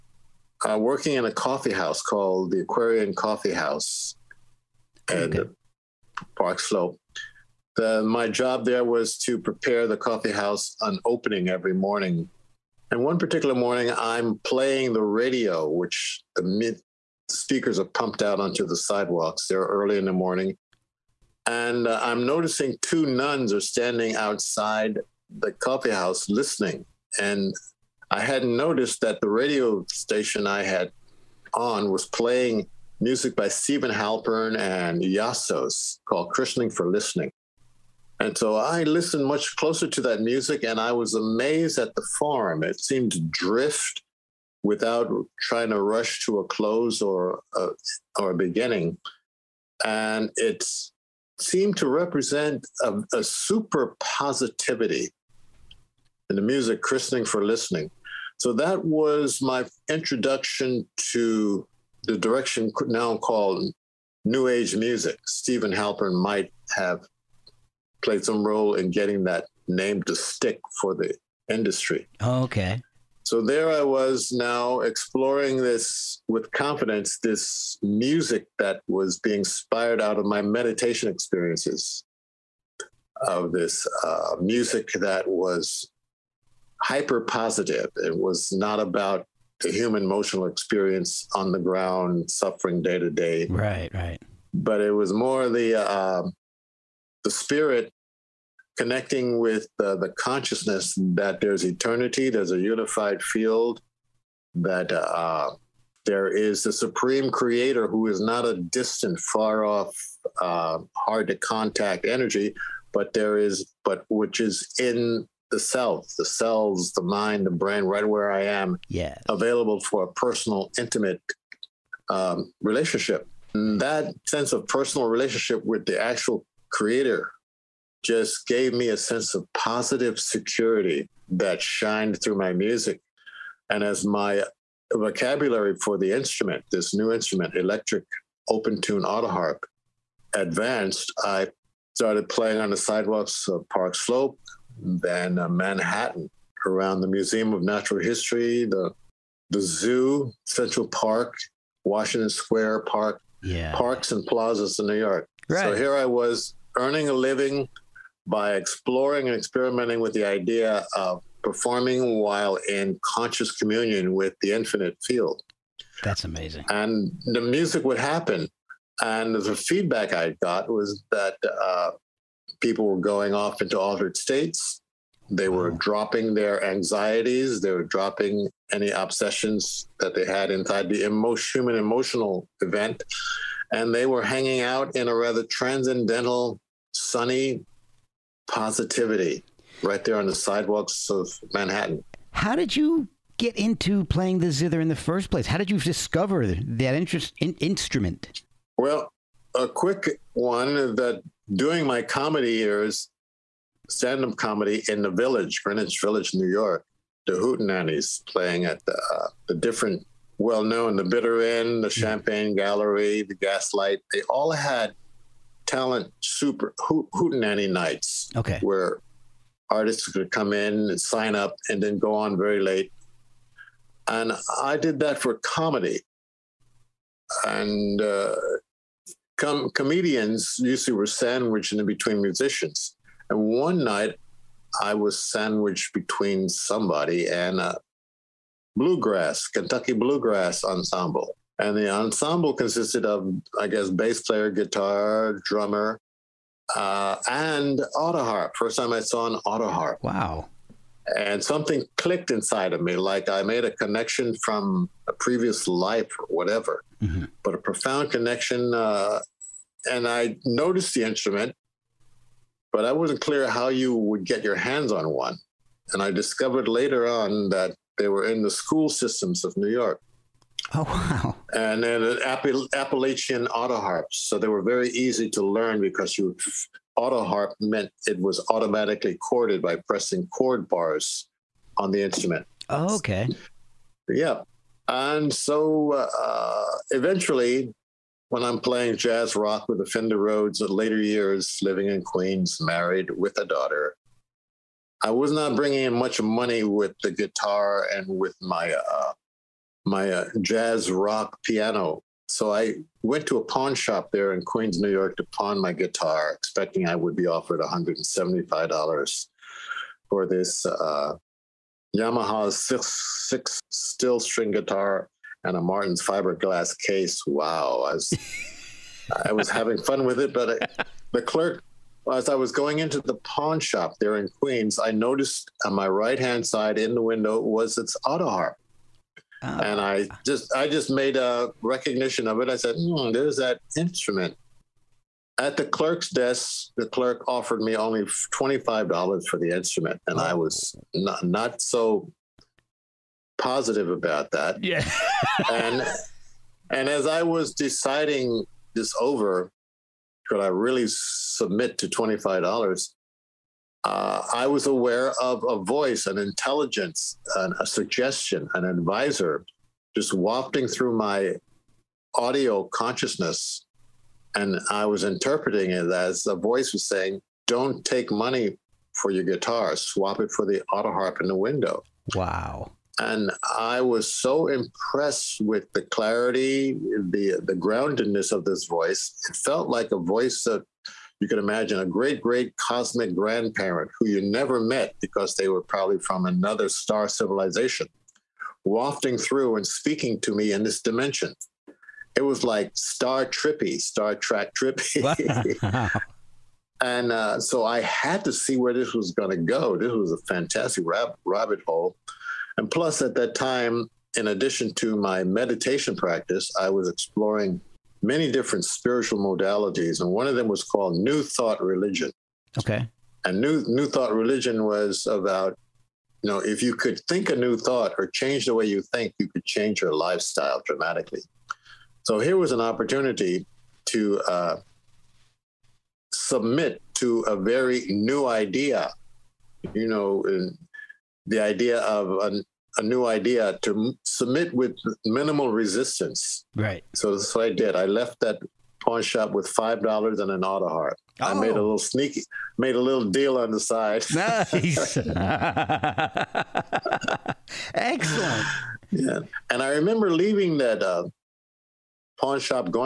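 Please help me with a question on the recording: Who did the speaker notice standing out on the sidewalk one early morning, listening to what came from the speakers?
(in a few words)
Two nuns.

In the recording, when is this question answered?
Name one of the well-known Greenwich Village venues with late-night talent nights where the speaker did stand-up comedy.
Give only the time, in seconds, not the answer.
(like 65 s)
210 s.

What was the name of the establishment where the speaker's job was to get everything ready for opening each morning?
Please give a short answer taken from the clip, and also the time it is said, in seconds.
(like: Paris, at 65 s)
Aquarian Coffee House, at 2 s.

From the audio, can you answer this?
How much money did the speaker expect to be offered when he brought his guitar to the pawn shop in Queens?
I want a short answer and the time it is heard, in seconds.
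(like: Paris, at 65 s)
$175, at 307 s.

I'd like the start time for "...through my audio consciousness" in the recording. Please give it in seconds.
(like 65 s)
360 s.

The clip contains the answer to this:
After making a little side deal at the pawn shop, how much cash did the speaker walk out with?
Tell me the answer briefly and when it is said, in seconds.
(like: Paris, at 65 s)
$5, at 439 s.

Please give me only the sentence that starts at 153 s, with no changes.
parks and plazas in New York.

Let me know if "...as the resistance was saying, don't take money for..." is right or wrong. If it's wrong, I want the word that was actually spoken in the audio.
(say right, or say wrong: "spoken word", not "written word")
wrong: "voice", not "resistance".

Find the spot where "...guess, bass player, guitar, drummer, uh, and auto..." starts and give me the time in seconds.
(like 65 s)
243 s.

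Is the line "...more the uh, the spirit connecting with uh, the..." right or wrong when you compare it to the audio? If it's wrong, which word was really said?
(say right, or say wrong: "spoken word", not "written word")
right.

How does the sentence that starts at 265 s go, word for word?
And I discovered later on that they were in the school systems of New York.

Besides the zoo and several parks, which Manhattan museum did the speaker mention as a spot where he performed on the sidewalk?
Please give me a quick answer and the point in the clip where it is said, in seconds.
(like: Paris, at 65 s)
Museum of Natural History, at 147 s.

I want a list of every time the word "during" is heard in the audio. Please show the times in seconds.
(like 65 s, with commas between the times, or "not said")
201 s.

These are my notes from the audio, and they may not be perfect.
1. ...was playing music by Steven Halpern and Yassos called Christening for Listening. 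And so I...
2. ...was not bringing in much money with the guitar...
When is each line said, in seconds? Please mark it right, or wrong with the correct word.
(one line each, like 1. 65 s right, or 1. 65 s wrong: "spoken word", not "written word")
1. 31 s right
2. 295 s right.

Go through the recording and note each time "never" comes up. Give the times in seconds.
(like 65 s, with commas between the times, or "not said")
384 s.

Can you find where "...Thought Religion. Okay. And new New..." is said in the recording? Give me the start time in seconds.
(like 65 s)
411 s.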